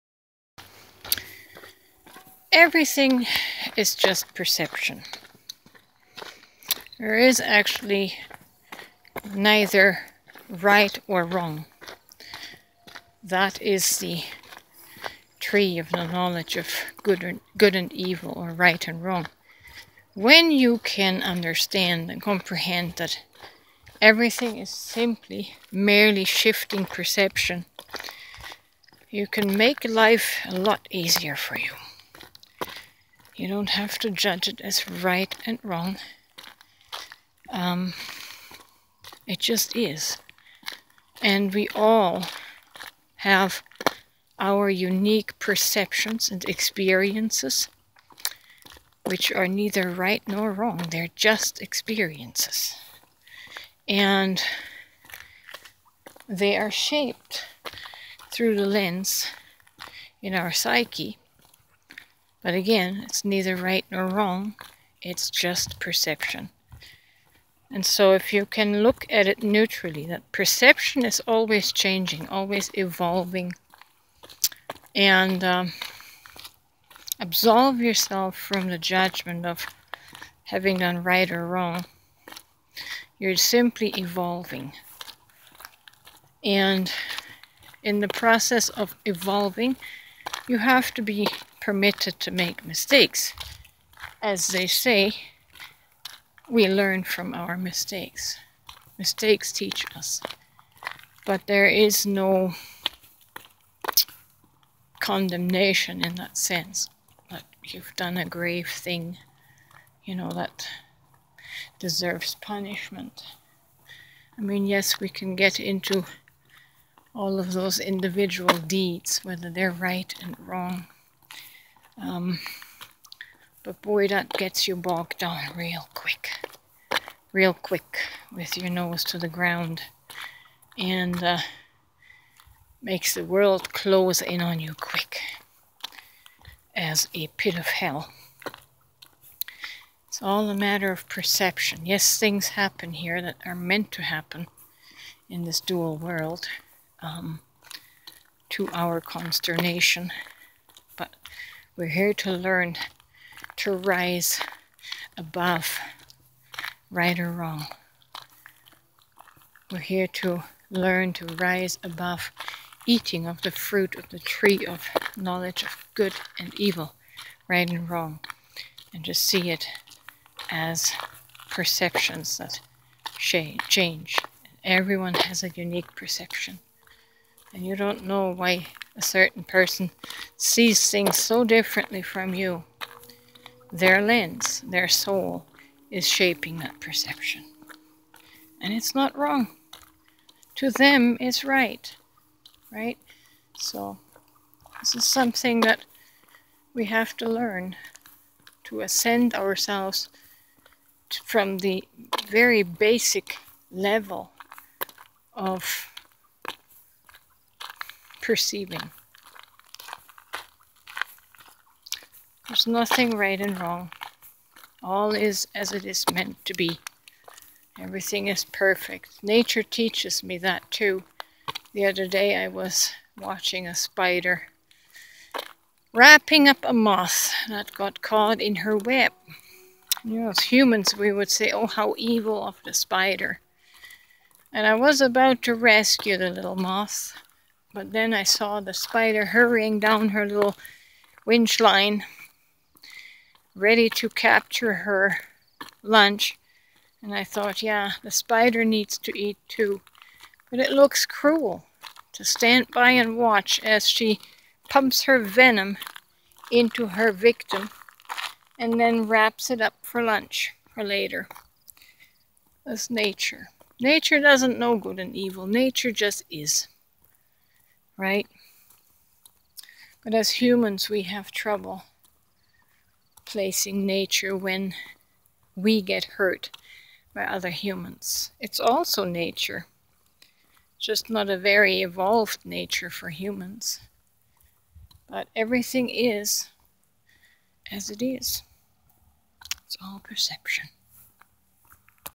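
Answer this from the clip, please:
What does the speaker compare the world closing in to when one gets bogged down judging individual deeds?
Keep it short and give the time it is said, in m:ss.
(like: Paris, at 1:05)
a pit of hell, at 2:17.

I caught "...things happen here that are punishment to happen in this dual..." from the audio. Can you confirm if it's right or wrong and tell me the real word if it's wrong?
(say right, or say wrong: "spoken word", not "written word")
wrong: "meant", not "punishment".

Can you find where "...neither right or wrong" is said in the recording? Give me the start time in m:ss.
0:09.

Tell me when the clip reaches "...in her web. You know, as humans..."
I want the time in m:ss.
3:48.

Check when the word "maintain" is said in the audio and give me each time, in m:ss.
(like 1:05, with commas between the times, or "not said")
not said.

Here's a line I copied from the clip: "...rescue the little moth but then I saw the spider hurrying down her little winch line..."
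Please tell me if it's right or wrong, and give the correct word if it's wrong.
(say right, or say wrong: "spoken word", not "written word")
right.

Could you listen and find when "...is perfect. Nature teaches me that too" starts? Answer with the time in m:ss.
3:38.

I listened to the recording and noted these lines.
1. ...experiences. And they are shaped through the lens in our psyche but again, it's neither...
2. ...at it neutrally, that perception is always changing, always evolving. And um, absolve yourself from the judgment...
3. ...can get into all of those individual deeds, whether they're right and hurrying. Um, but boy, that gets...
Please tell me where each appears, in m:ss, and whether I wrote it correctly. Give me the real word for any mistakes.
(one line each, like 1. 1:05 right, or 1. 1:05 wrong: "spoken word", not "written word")
1. 0:51 right
2. 1:09 right
3. 1:55 wrong: "wrong", not "hurrying".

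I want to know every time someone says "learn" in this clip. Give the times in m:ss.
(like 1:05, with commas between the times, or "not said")
1:36, 2:32, 2:40, 3:17.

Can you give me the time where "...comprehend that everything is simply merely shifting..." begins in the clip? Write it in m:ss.
0:22.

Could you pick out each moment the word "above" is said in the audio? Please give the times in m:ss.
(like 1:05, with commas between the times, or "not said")
2:35, 2:41.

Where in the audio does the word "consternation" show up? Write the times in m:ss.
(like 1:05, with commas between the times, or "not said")
2:29.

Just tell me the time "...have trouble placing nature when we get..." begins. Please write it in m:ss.
4:31.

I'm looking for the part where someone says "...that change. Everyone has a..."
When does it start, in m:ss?
2:52.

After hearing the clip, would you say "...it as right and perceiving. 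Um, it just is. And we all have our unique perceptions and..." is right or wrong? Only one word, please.
wrong.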